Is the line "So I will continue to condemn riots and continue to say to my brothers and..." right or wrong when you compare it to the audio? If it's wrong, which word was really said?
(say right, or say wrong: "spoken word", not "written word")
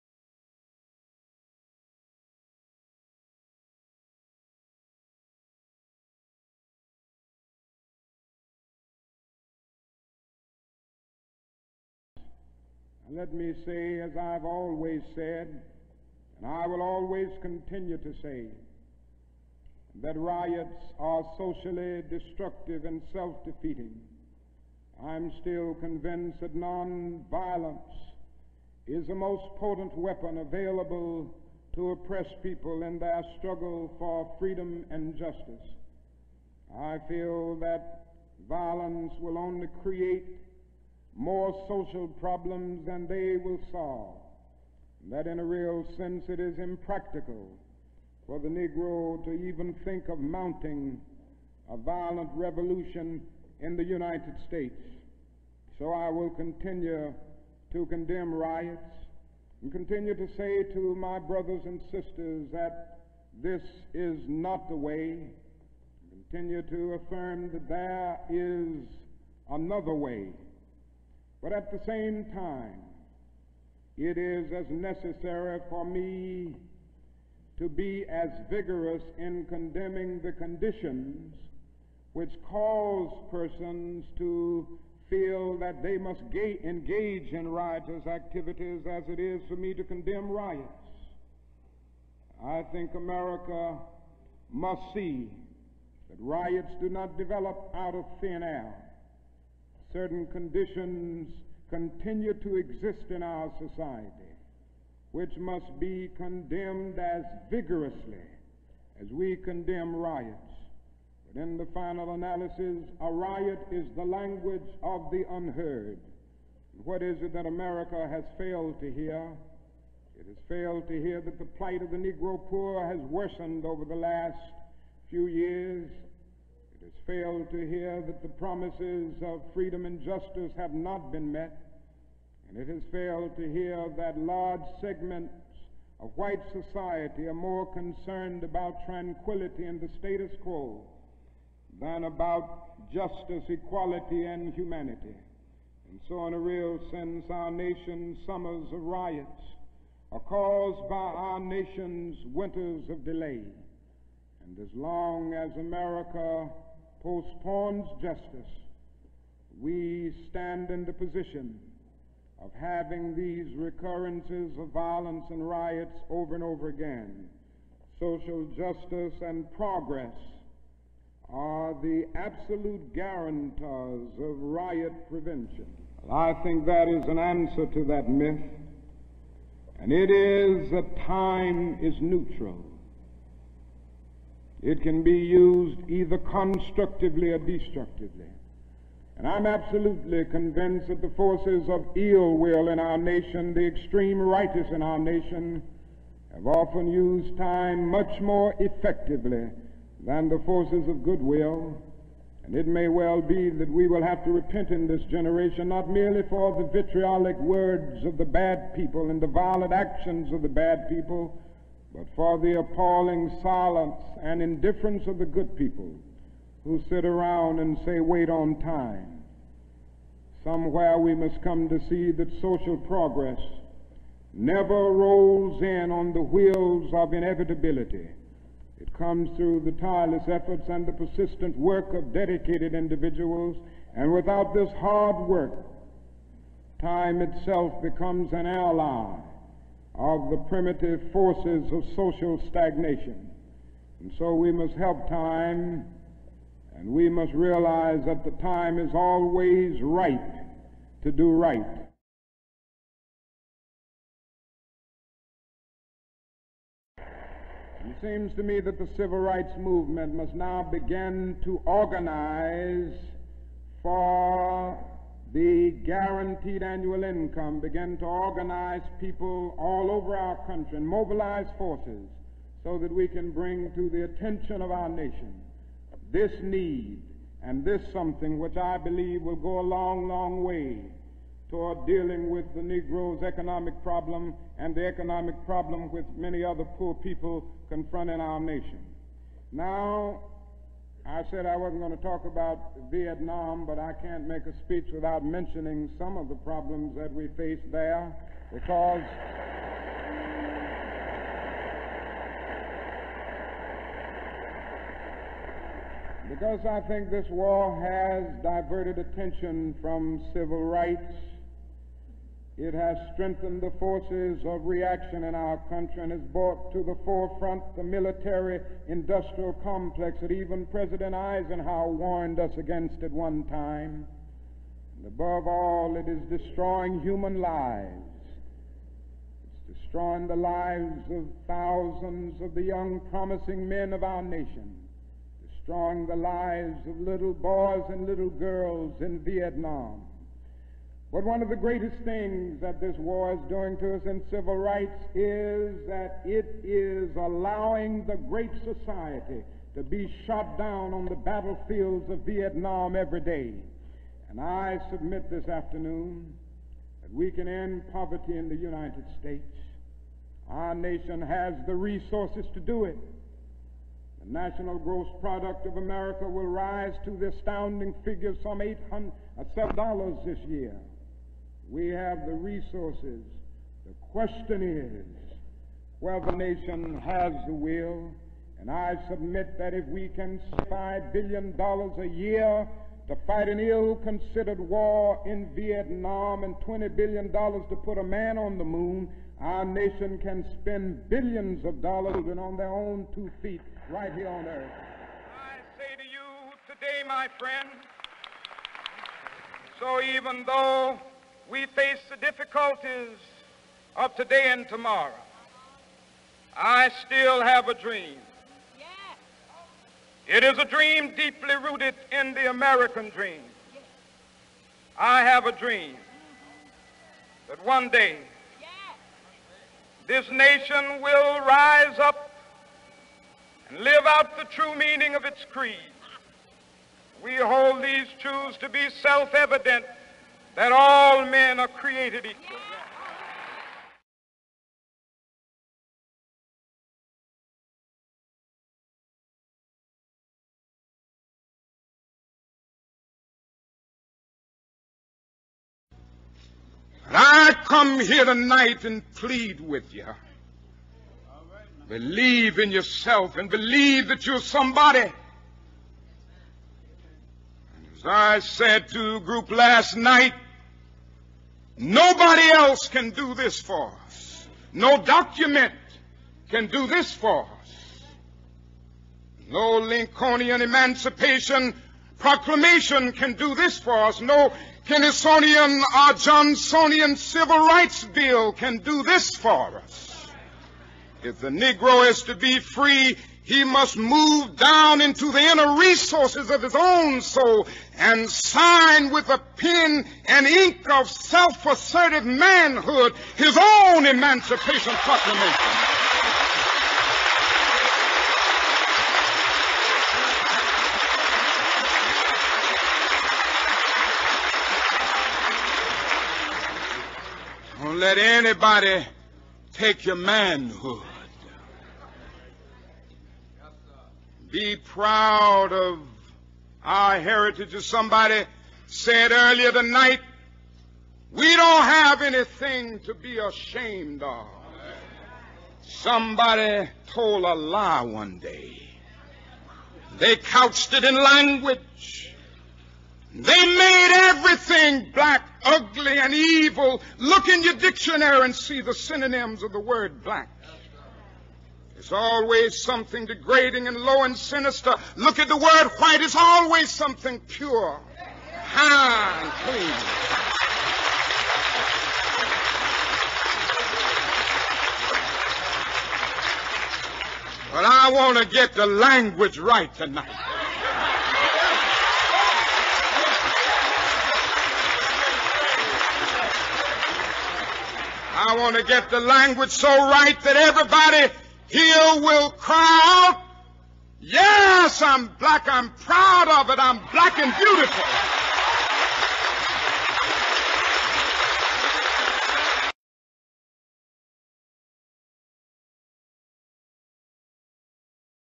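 right.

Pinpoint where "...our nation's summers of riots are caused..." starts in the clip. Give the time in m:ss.
2:27.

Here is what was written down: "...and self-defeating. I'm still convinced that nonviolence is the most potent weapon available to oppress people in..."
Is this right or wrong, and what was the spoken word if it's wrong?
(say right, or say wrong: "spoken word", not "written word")
right.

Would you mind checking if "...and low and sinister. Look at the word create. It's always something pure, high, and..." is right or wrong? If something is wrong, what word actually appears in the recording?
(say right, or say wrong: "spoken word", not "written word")
wrong: "white", not "create".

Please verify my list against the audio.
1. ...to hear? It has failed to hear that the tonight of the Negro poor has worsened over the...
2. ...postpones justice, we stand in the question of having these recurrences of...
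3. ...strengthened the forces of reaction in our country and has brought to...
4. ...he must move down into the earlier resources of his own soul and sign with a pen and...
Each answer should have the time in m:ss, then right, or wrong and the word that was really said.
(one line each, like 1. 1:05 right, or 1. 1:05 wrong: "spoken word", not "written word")
1. 1:58 wrong: "plight", not "tonight"
2. 2:37 wrong: "position", not "question"
3. 5:13 right
4. 8:03 wrong: "inner", not "earlier".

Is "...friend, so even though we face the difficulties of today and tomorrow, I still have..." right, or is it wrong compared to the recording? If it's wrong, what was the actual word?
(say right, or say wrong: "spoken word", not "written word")
right.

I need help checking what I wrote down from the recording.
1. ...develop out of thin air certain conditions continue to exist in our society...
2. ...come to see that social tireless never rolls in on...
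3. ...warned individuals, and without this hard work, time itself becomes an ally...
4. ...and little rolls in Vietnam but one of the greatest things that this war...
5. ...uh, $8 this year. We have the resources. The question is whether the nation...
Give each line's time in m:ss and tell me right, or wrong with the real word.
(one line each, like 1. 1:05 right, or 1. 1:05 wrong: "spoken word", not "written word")
1. 1:37 right
2. 3:41 wrong: "progress", not "tireless"
3. 3:52 wrong: "dedicated", not "warned"
4. 5:37 wrong: "girls", not "rolls"
5. 6:09 wrong: "7", not "8".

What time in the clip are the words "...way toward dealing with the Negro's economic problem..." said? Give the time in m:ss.
4:40.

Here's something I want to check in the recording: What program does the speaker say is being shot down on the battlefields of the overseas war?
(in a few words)
the great society.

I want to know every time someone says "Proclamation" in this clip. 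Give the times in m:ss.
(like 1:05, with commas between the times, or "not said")
7:52, 8:14.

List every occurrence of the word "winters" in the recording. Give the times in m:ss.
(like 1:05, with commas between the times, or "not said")
2:32.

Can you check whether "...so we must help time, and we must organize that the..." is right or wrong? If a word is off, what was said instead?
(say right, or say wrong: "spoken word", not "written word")
wrong: "realize", not "organize".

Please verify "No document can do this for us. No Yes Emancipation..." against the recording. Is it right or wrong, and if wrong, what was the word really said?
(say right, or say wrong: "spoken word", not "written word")
wrong: "Lincolnian", not "Yes".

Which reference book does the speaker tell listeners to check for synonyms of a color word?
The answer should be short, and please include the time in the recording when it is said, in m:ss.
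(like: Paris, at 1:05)
dictionary, at 8:57.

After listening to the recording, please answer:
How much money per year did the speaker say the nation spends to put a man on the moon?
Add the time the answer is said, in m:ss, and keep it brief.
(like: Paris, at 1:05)
$20 billion, at 6:26.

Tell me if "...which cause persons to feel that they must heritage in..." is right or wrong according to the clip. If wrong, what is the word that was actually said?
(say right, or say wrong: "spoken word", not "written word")
wrong: "engage", not "heritage".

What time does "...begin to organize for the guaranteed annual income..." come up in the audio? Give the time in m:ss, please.
4:20.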